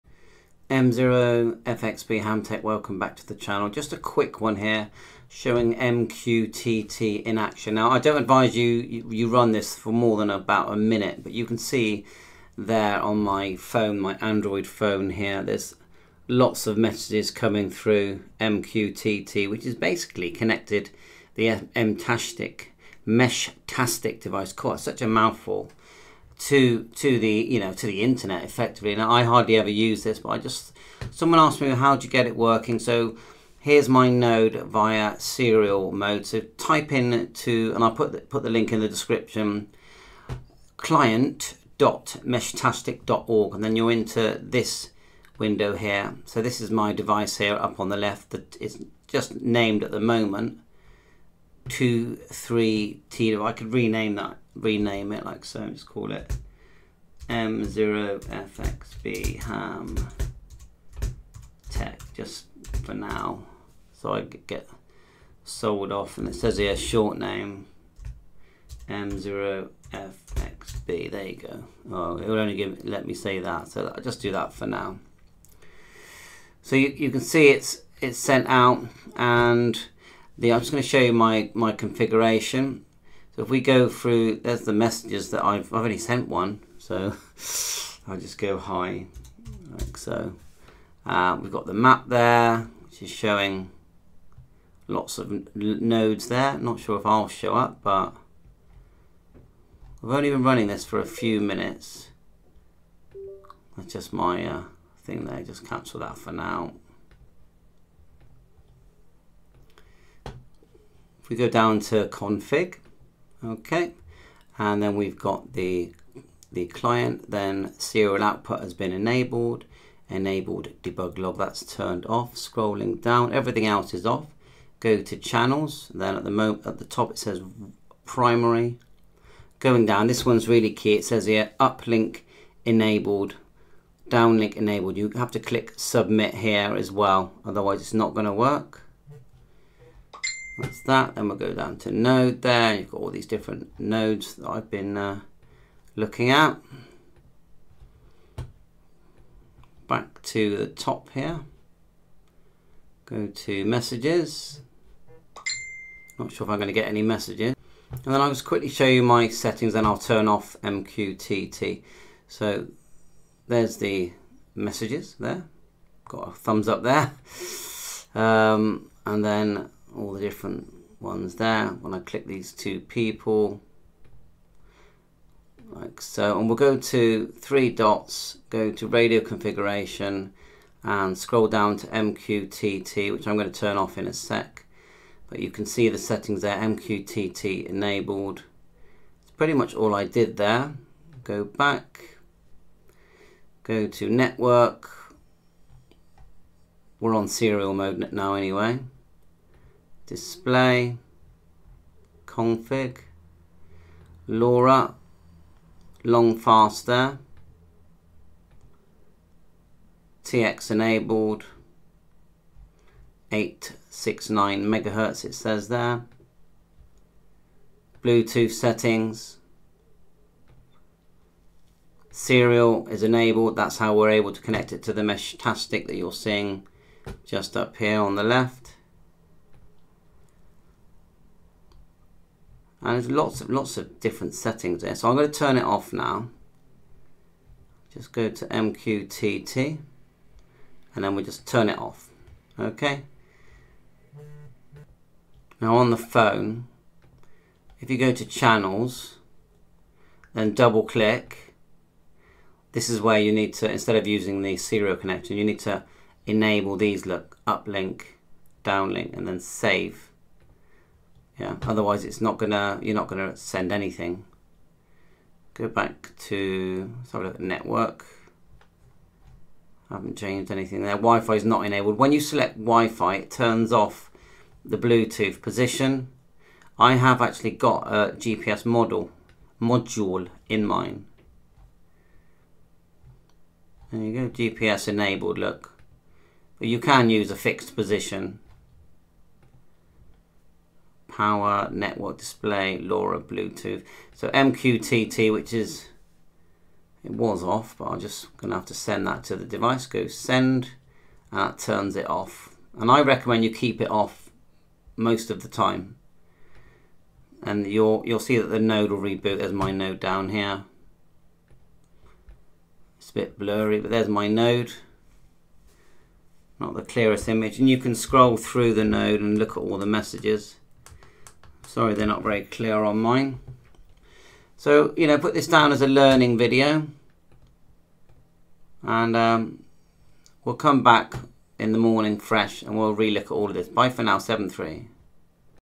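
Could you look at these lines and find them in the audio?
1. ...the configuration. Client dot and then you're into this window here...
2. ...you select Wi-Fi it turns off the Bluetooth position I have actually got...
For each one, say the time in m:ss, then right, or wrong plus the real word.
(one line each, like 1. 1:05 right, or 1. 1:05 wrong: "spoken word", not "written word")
1. 0:38 wrong: "description", not "configuration"
2. 4:32 right.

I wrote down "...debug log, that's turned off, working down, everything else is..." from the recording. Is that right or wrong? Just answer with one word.
wrong.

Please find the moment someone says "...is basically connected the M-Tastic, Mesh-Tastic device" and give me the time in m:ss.
0:19.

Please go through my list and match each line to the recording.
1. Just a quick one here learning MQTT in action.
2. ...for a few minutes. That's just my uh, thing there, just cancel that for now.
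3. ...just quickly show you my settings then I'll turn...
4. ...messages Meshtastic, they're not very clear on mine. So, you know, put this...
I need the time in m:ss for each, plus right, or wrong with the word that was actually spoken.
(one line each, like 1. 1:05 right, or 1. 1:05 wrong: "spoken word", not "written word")
1. 0:03 wrong: "showing", not "learning"
2. 1:40 right
3. 2:38 right
4. 5:19 wrong: "Sorry", not "Meshtastic".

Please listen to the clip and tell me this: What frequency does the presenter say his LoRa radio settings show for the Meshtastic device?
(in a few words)
869 MHz.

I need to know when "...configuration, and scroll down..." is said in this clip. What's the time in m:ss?
2:59.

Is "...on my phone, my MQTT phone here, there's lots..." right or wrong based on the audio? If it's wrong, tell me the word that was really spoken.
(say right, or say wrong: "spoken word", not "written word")
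wrong: "Android", not "MQTT".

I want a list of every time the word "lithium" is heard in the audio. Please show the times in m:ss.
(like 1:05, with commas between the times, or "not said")
not said.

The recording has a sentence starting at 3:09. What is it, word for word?
It's pretty much all I did there.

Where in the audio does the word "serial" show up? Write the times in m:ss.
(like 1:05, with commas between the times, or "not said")
0:35, 1:57, 3:17, 3:42, 4:14.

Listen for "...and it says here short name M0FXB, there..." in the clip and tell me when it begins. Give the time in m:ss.
1:06.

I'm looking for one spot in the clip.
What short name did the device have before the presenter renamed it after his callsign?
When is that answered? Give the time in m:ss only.
0:51.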